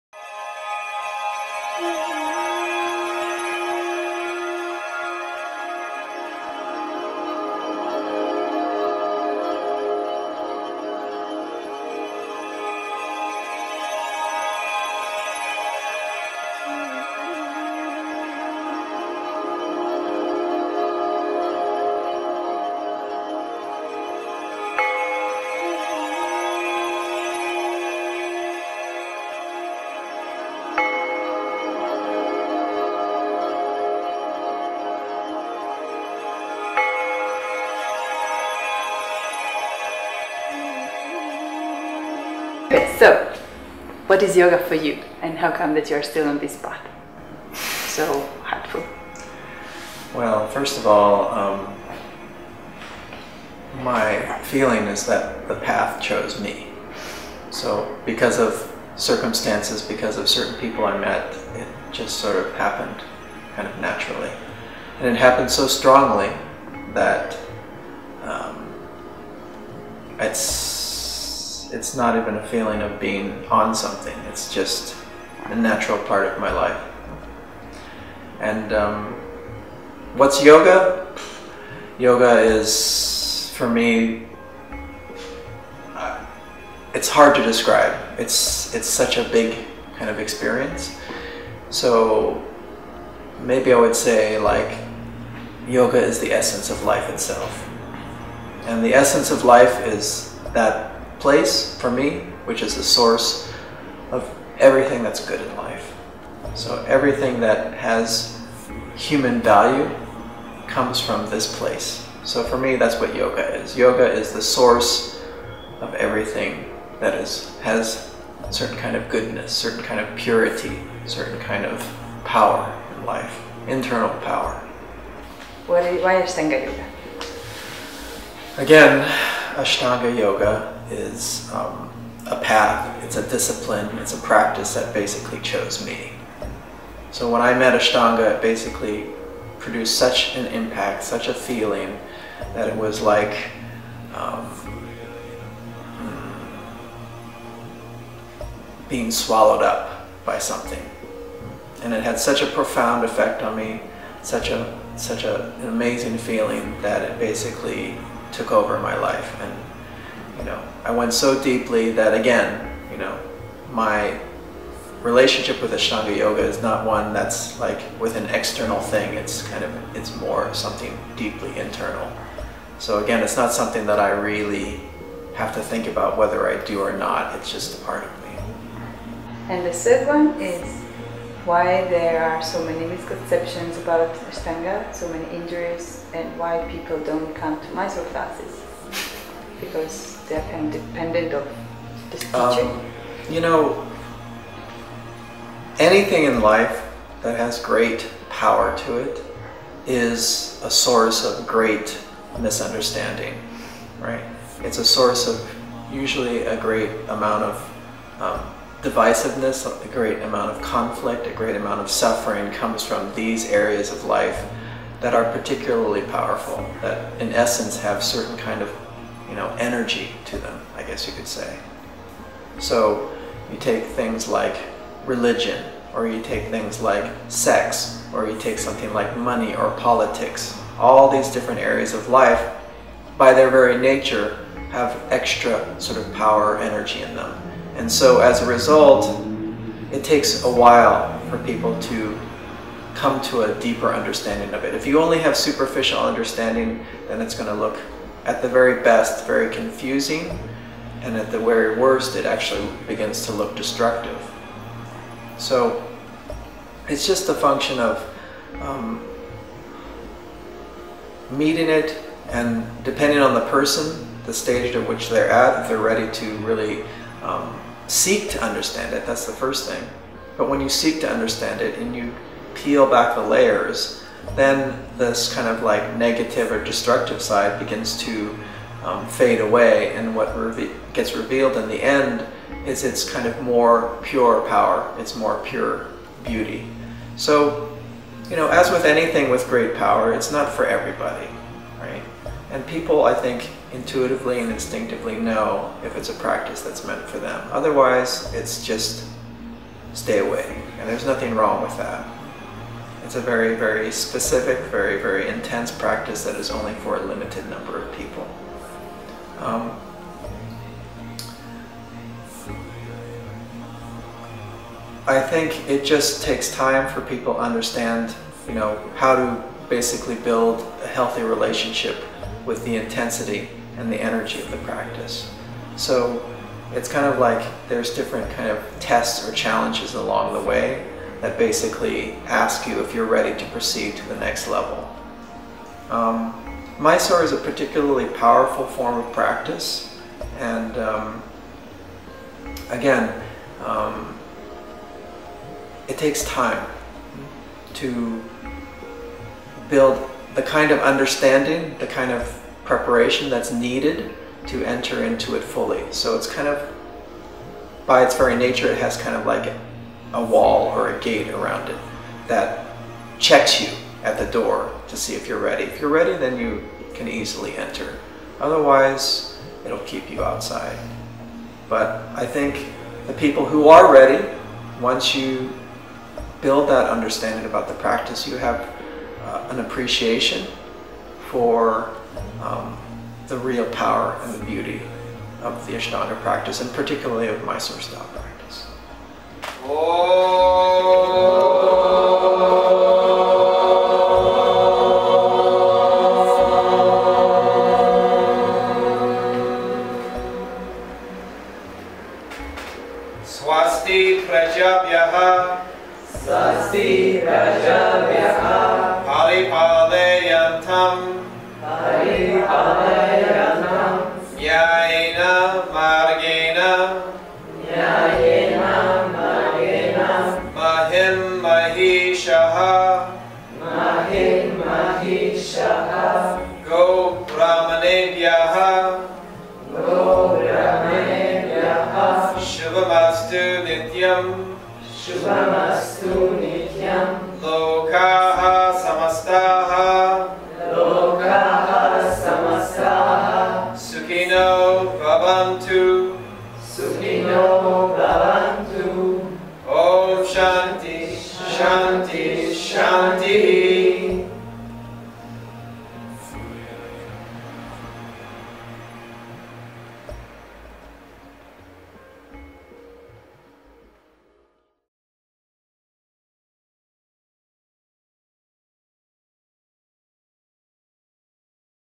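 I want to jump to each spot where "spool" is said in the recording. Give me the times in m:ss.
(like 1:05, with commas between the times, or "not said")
not said.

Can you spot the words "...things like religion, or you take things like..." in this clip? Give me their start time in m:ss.
3:43.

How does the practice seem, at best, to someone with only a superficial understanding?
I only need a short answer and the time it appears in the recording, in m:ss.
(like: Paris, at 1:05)
very confusing, at 4:09.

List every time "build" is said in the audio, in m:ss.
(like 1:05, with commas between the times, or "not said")
5:20, 5:49, 6:16.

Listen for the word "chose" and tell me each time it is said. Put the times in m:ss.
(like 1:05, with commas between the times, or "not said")
0:56, 2:15.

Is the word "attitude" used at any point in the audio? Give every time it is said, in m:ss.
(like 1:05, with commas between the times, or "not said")
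not said.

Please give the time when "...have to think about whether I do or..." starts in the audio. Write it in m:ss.
2:55.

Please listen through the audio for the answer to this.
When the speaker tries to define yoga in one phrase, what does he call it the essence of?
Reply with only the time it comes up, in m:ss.
1:36.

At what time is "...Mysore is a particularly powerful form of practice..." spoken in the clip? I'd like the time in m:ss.
5:36.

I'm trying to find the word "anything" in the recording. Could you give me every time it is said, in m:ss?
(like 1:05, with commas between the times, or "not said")
3:15, 4:48.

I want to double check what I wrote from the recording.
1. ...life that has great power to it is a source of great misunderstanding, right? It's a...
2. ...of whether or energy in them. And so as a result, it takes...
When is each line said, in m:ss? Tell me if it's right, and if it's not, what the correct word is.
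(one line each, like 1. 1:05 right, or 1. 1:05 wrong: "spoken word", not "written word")
1. 3:16 right
2. 3:56 wrong: "power", not "whether".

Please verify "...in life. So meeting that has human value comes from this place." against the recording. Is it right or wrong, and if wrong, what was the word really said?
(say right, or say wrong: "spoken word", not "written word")
wrong: "everything", not "meeting".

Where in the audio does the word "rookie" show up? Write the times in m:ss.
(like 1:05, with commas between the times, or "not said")
not said.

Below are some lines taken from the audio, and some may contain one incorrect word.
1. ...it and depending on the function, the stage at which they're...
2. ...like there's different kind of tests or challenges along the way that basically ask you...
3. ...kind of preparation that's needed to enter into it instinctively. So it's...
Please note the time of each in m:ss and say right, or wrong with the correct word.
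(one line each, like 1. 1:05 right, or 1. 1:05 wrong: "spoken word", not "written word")
1. 4:21 wrong: "person", not "function"
2. 5:27 right
3. 5:51 wrong: "fully", not "instinctively".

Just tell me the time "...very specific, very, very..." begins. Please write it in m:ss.
5:03.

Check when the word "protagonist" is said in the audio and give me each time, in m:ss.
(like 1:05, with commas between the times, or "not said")
not said.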